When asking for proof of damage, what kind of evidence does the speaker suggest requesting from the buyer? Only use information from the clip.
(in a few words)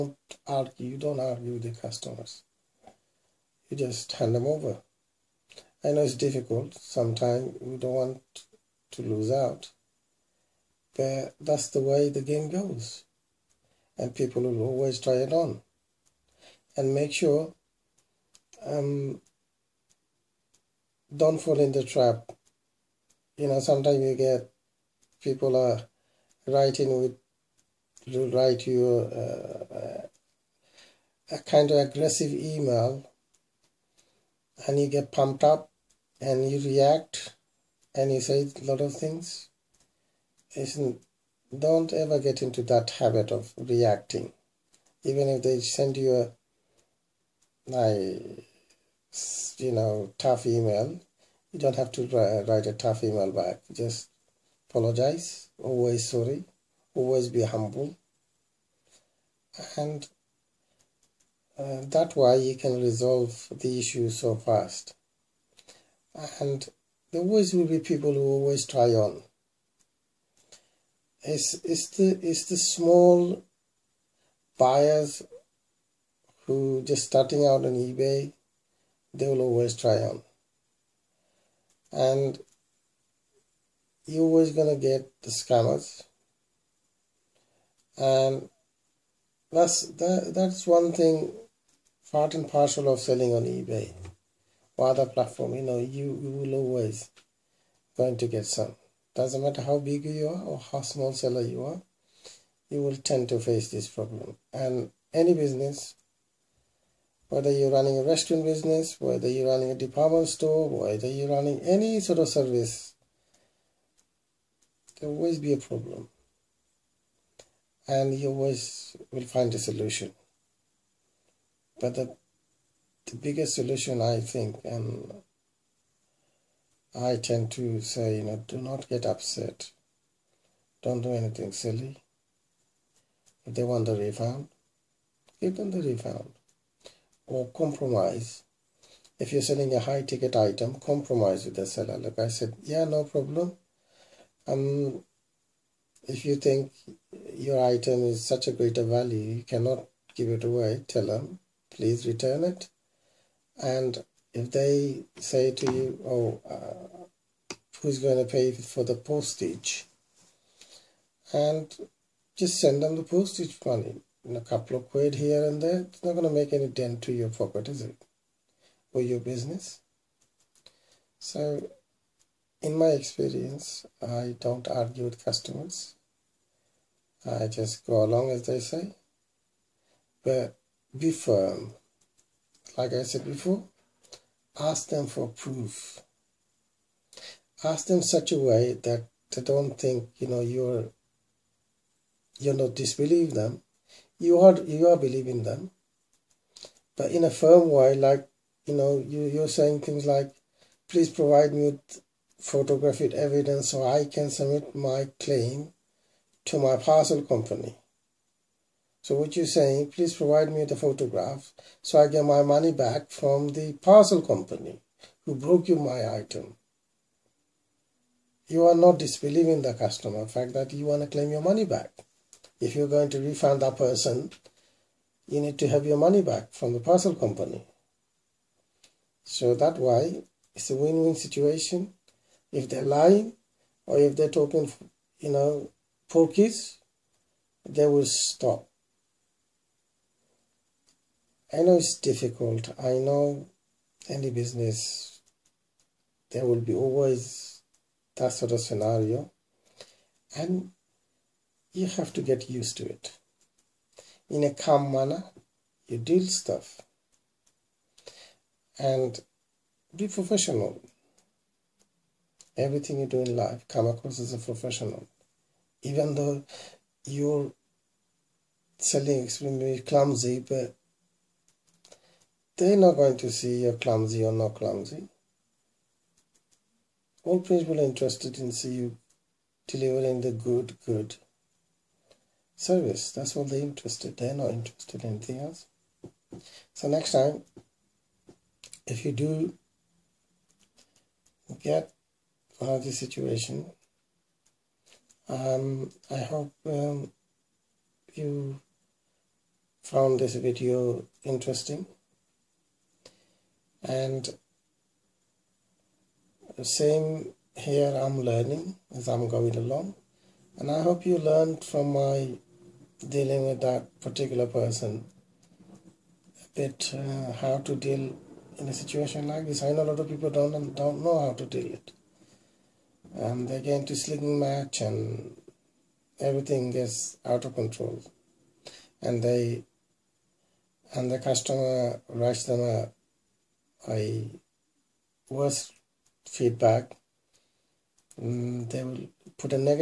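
photographic evidence.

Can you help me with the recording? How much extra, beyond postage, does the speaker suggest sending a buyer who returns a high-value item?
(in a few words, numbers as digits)
a couple of quid.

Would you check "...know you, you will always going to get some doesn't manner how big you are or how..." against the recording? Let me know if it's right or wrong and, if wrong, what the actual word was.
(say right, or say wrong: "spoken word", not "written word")
wrong: "matter", not "manner".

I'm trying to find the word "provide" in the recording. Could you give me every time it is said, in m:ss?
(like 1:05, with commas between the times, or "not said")
3:21, 3:30.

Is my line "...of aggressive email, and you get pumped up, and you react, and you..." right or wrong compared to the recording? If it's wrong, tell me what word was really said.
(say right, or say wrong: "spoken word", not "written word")
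right.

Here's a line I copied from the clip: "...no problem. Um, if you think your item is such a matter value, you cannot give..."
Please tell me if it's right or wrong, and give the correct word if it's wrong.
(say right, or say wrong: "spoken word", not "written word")
wrong: "greater", not "matter".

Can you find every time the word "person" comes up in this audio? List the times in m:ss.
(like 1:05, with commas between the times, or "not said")
3:43, 5:14.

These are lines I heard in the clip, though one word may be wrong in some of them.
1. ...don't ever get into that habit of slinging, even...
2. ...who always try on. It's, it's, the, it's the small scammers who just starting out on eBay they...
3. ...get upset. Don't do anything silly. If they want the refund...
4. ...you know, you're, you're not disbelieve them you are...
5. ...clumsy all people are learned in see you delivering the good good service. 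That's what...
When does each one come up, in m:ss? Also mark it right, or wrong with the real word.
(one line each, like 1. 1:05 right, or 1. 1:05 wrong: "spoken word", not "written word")
1. 0:41 wrong: "reacting", not "slinging"
2. 1:08 wrong: "buyers", not "scammers"
3. 2:08 right
4. 3:10 right
5. 4:34 wrong: "interested", not "learned".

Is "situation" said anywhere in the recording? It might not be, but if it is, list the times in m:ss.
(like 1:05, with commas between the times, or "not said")
3:51, 4:52, 5:18.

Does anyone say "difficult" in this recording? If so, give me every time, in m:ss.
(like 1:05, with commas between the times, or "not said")
0:06, 4:01.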